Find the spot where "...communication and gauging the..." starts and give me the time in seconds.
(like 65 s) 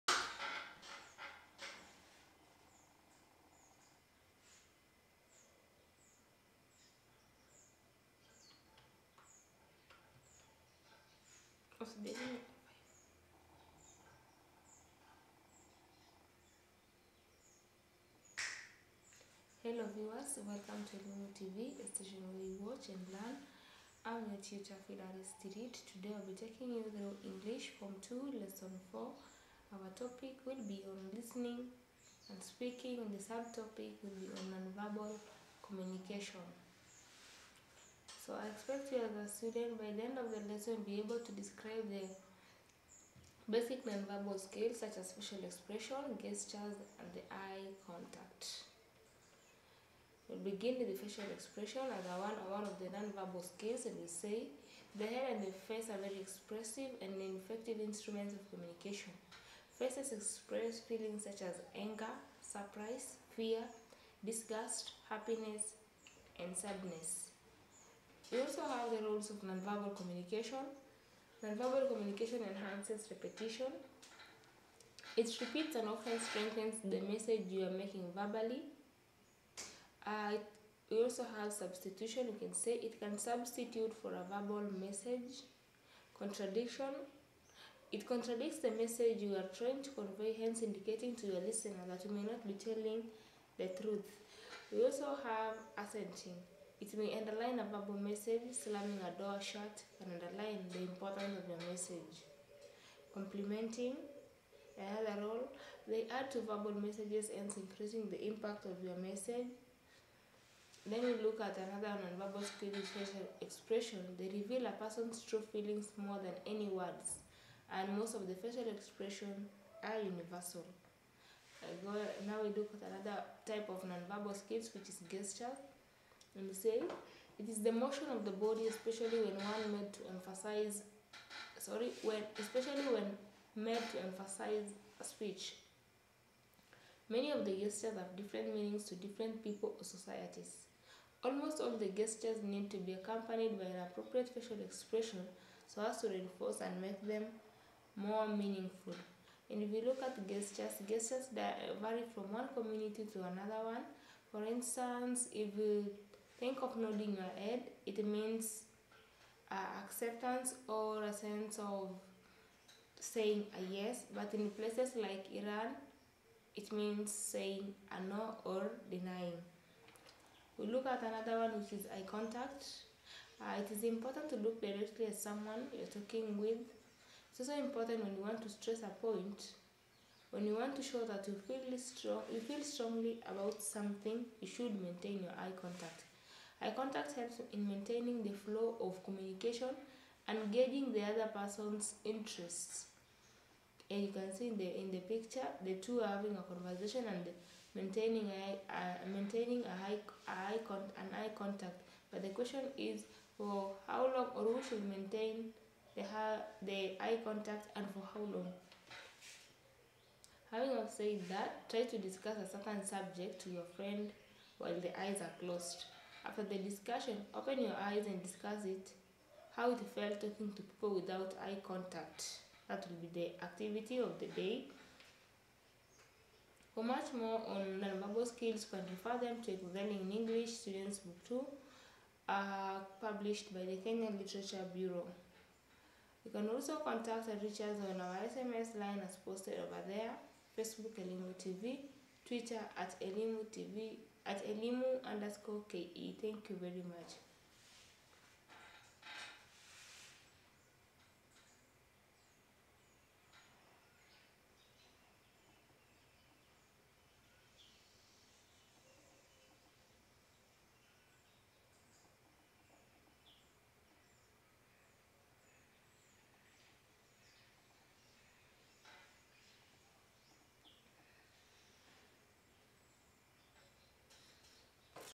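189 s.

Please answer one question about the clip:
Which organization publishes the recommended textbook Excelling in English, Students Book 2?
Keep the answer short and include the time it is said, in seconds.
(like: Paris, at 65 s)
Kenyan Literature Bureau, at 233 s.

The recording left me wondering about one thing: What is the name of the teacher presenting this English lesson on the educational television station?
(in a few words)
Fidaris Tirit.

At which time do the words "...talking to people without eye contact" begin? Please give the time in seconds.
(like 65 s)
220 s.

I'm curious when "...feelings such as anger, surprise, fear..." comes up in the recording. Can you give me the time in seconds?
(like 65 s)
60 s.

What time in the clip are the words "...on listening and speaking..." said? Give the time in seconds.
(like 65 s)
30 s.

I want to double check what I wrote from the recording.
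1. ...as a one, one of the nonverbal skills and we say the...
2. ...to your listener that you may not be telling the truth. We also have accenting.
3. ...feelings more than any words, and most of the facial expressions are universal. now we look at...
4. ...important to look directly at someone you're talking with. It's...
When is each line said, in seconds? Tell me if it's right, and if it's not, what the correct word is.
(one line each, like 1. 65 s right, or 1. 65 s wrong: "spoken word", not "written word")
1. 51 s right
2. 91 s right
3. 115 s right
4. 173 s right.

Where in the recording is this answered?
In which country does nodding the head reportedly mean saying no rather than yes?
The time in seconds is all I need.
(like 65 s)
165 s.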